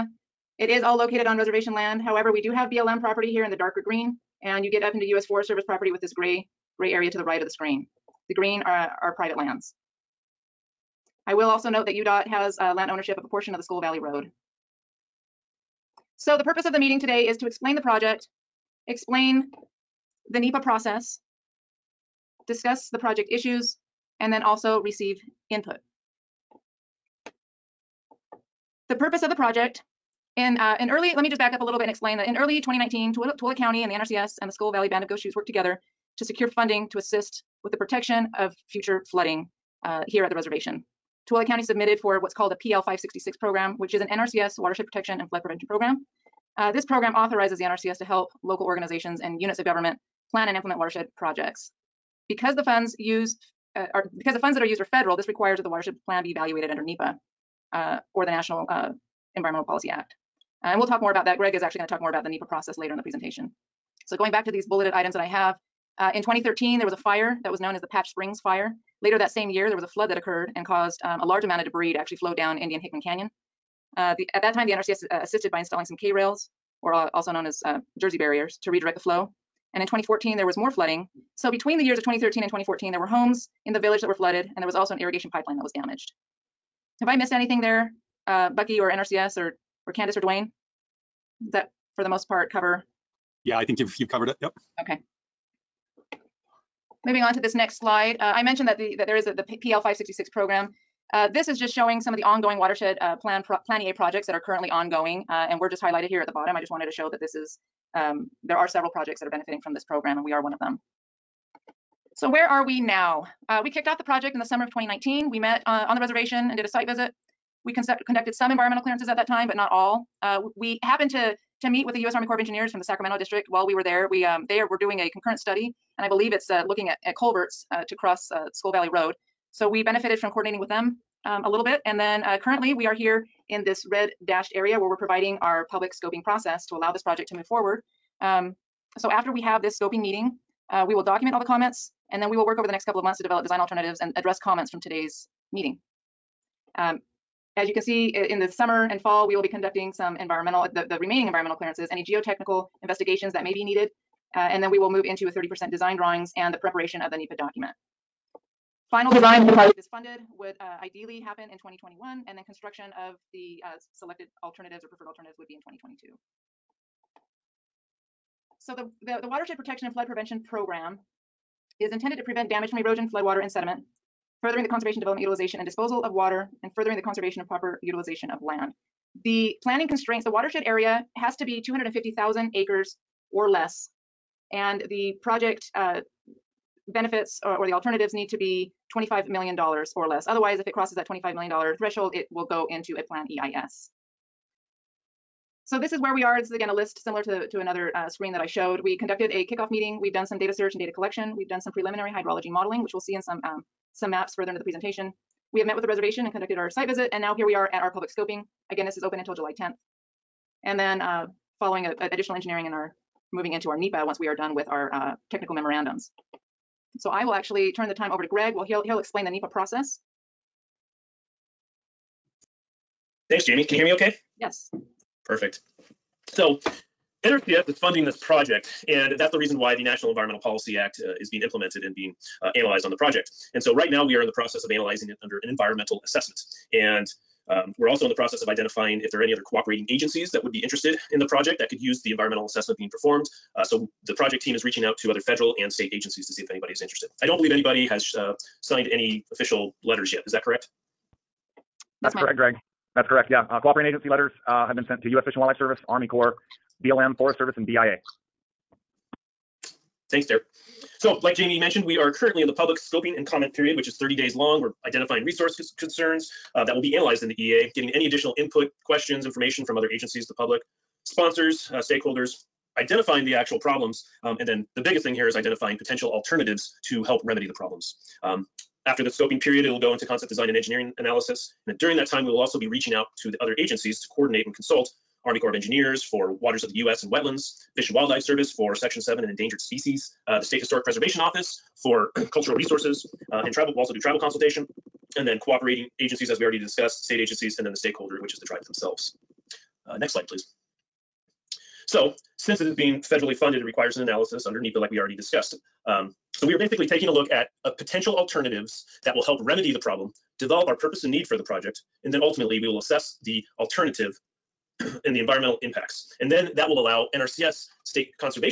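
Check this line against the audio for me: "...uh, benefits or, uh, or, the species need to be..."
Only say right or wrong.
wrong.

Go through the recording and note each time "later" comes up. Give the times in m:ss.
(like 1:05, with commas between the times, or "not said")
1:02, 1:09.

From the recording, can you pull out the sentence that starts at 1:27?
Have I missed anything there, uh, Bucky or NRCS or, or Candace or Dwayne?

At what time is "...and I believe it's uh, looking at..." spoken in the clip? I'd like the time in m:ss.
2:05.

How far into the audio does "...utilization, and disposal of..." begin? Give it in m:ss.
2:55.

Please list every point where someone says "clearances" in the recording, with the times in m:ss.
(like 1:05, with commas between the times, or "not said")
1:58, 2:31.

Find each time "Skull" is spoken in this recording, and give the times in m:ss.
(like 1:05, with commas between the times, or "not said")
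0:13, 0:34, 2:08.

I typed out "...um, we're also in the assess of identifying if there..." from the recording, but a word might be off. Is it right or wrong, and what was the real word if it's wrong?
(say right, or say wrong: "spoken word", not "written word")
wrong: "process", not "assess".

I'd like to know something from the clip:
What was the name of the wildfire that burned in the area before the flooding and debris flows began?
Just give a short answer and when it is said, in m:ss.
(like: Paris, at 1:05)
Patch Springs Fire, at 1:07.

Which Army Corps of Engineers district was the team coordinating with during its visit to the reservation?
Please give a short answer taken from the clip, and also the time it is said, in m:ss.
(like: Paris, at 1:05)
Sacramento, at 2:02.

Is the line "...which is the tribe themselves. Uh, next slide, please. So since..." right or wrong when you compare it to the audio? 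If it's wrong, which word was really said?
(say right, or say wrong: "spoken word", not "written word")
right.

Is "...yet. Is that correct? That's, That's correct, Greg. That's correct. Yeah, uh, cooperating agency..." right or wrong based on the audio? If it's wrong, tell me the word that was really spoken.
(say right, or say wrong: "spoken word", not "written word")
right.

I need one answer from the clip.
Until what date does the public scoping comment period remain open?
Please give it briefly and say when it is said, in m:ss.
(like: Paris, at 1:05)
July 10th, at 3:29.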